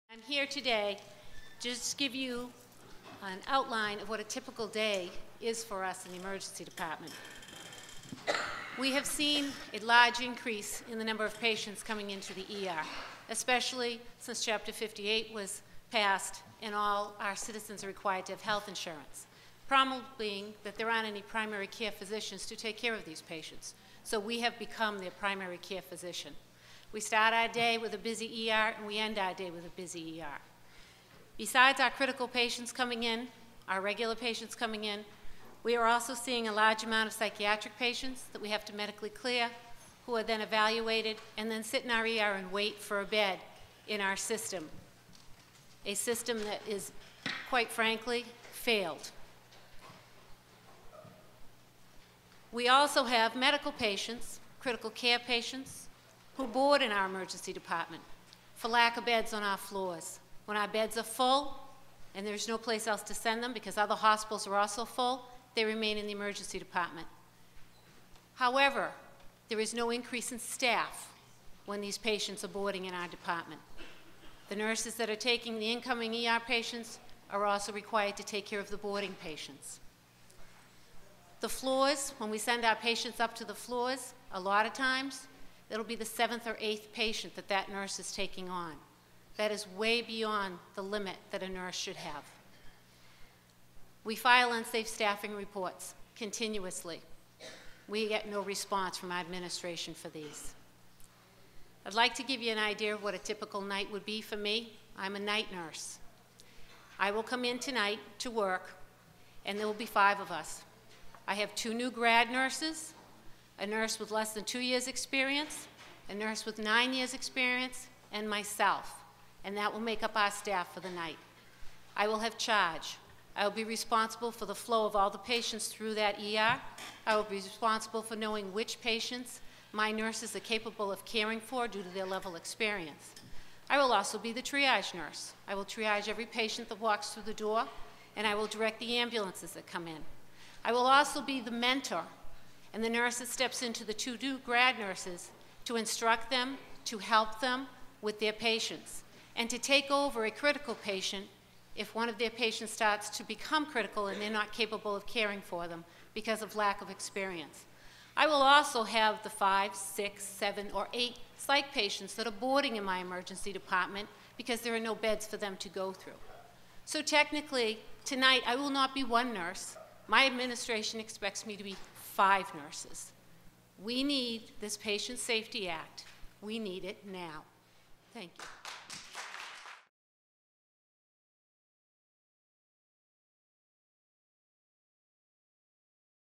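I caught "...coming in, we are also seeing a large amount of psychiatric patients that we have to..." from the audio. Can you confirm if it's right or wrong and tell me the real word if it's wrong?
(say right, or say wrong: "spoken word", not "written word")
right.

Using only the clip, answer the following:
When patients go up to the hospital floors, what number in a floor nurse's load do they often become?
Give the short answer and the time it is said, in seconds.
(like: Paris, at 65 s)
7th or 8th, at 86 s.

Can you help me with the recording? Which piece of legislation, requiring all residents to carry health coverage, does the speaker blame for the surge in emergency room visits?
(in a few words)
Chapter 58.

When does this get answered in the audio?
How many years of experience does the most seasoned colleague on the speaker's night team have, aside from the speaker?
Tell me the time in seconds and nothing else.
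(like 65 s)
116 s.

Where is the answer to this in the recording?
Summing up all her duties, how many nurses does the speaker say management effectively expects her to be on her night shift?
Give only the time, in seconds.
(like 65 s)
172 s.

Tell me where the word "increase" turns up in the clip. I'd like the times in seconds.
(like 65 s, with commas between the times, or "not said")
10 s, 69 s.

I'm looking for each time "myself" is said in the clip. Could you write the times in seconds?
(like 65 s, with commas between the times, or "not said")
118 s.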